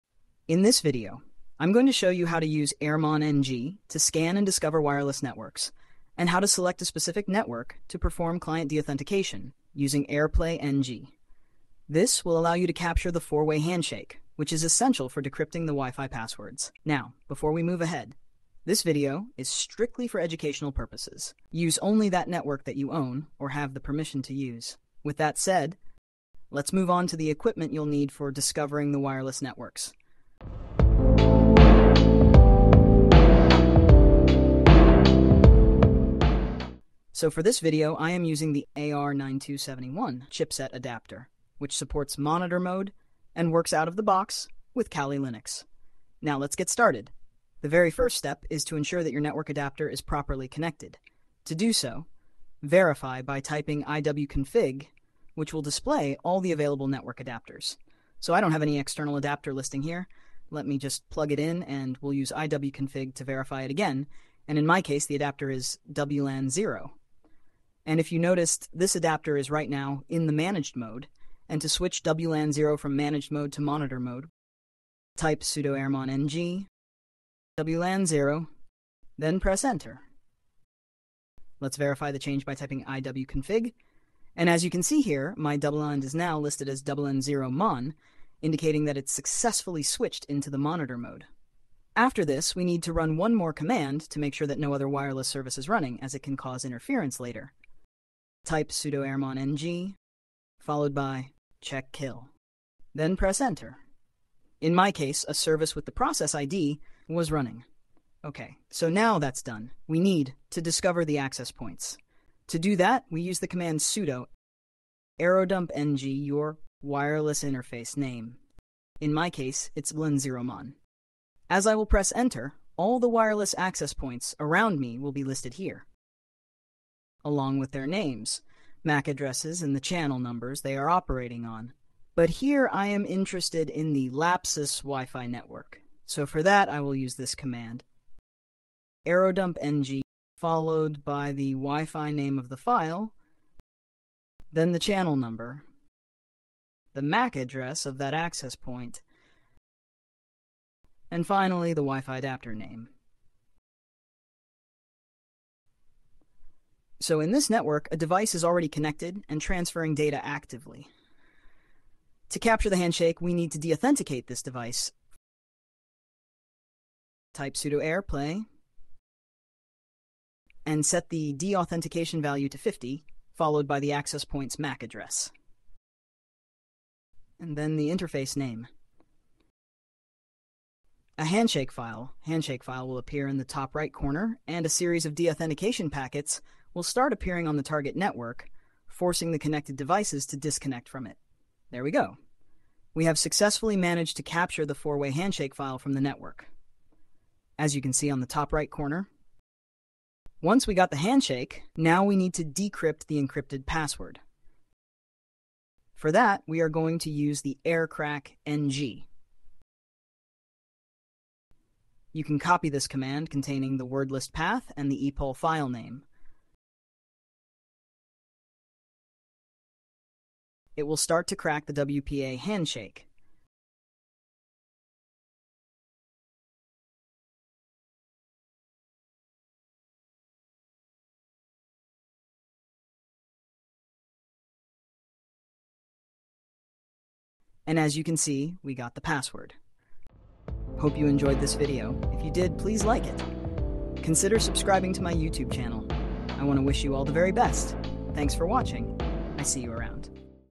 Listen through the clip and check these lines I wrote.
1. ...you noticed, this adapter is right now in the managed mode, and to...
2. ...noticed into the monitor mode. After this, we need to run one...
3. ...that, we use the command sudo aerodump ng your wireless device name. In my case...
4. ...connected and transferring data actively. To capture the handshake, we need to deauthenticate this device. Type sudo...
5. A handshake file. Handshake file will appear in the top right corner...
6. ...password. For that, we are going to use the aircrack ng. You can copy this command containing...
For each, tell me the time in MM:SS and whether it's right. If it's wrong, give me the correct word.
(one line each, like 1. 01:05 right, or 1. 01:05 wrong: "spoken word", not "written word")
1. 01:08 right
2. 01:29 wrong: "switched", not "noticed"
3. 01:52 wrong: "interface", not "device"
4. 02:38 right
5. 03:01 right
6. 03:23 right.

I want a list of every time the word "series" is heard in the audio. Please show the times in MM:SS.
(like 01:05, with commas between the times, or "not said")
03:04.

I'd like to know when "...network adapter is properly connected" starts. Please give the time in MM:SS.
00:49.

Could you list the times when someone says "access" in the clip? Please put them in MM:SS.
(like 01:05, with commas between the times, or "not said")
01:51, 02:03, 02:28, 02:53.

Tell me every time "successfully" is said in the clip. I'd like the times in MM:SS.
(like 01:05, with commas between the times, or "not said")
01:29, 03:13.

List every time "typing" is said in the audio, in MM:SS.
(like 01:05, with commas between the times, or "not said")
00:53, 01:22.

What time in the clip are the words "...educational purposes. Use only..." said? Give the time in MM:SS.
00:20.